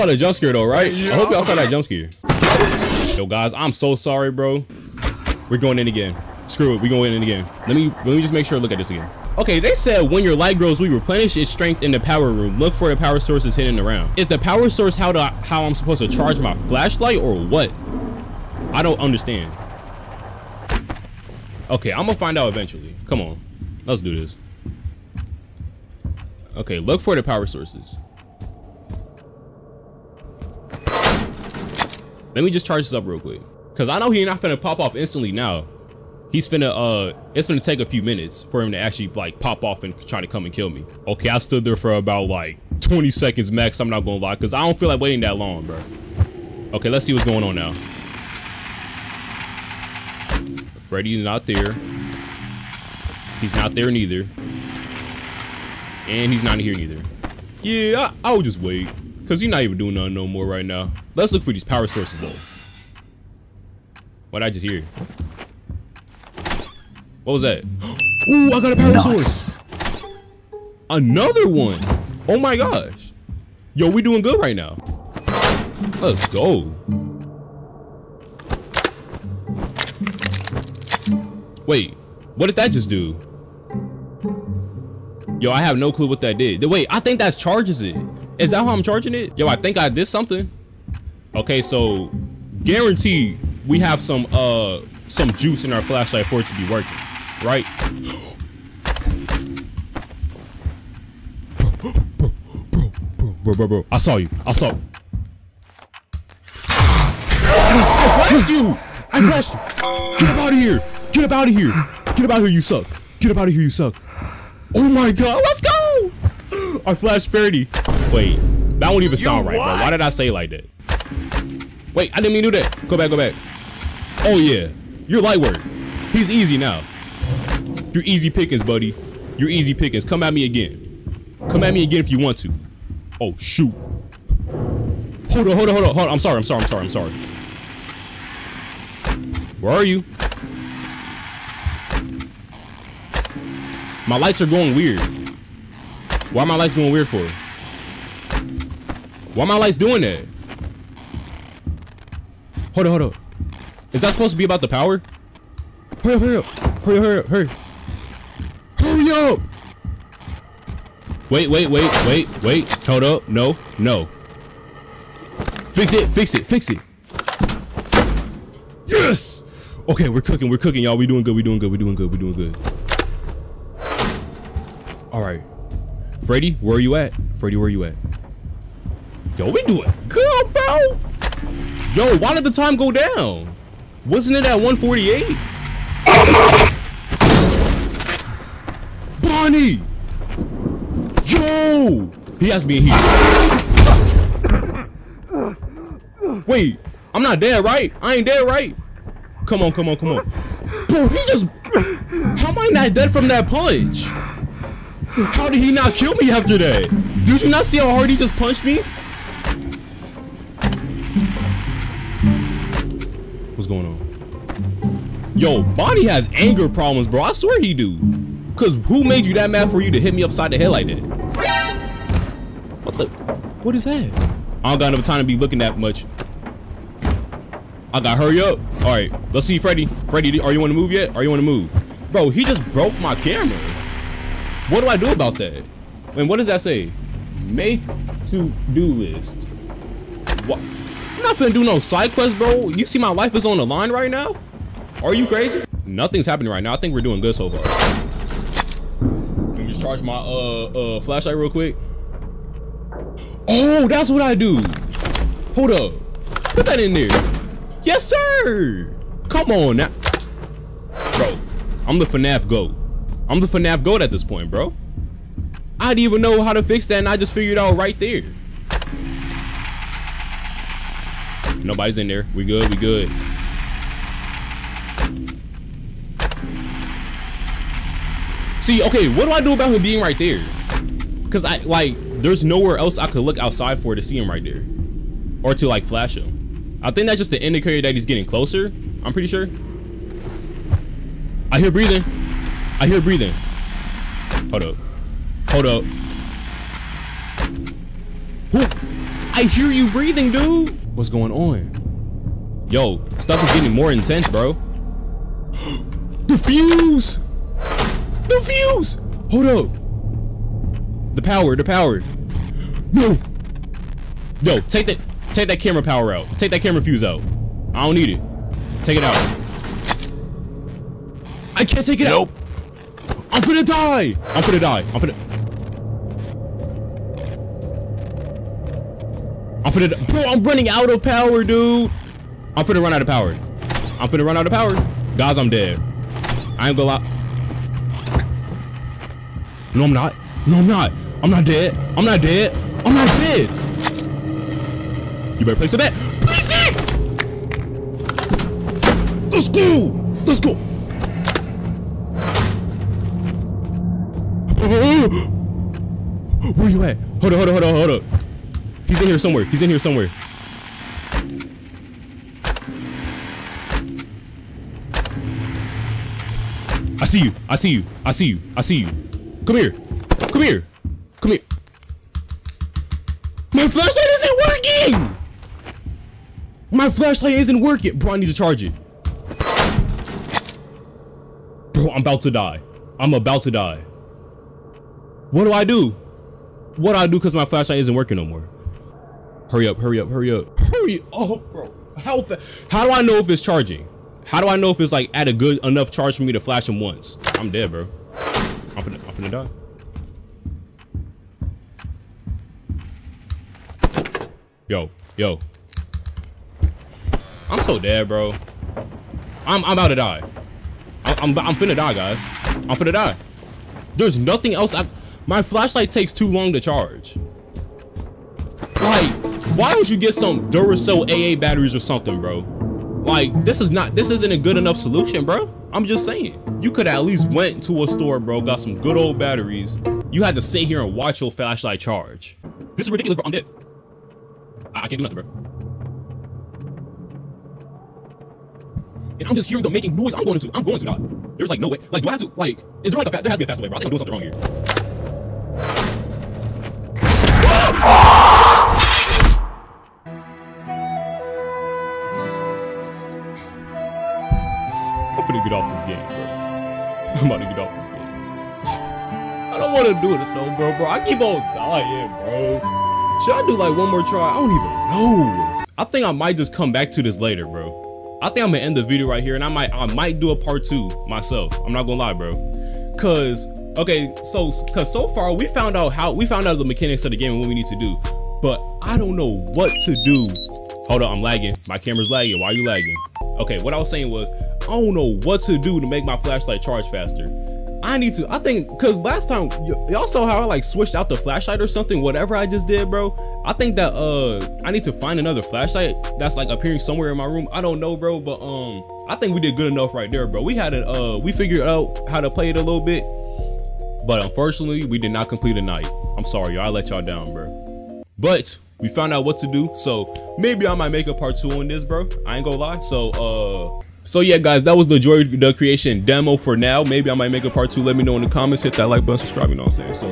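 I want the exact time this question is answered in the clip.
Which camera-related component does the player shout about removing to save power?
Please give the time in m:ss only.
5:16.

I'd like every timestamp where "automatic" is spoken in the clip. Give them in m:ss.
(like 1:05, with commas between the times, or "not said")
not said.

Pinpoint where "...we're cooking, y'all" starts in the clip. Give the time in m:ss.
2:50.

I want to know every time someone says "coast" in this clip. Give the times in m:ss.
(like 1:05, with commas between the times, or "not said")
not said.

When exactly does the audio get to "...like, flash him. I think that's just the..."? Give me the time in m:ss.
4:45.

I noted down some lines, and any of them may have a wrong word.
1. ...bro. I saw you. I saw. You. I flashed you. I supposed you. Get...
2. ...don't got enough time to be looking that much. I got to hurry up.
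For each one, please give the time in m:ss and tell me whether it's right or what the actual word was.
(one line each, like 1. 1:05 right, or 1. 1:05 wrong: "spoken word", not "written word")
1. 1:43 wrong: "flashed", not "supposed"
2. 3:44 right.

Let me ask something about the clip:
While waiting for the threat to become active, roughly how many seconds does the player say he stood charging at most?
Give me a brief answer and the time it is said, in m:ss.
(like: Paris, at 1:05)
20 seconds, at 0:42.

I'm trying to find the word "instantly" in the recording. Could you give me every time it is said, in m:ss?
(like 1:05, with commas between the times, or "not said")
0:34.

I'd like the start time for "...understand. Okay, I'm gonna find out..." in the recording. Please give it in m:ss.
0:18.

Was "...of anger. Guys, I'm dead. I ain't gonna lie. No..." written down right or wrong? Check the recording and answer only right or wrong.
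wrong.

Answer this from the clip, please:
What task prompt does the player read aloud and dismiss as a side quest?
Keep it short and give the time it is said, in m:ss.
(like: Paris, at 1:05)
Make to-do list, at 3:57.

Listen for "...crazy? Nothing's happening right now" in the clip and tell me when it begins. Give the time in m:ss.
4:05.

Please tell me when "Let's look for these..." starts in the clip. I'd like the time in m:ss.
1:01.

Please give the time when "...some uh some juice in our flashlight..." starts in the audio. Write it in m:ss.
1:34.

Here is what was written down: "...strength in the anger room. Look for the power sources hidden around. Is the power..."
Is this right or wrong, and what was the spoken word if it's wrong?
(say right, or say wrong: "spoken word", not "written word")
wrong: "power", not "anger".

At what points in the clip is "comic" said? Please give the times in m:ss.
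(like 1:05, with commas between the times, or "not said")
not said.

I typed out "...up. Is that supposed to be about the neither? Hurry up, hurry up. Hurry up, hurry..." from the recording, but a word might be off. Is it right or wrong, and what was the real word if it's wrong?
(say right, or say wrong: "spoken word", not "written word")
wrong: "power", not "neither".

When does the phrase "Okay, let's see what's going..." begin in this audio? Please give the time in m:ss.
0:46.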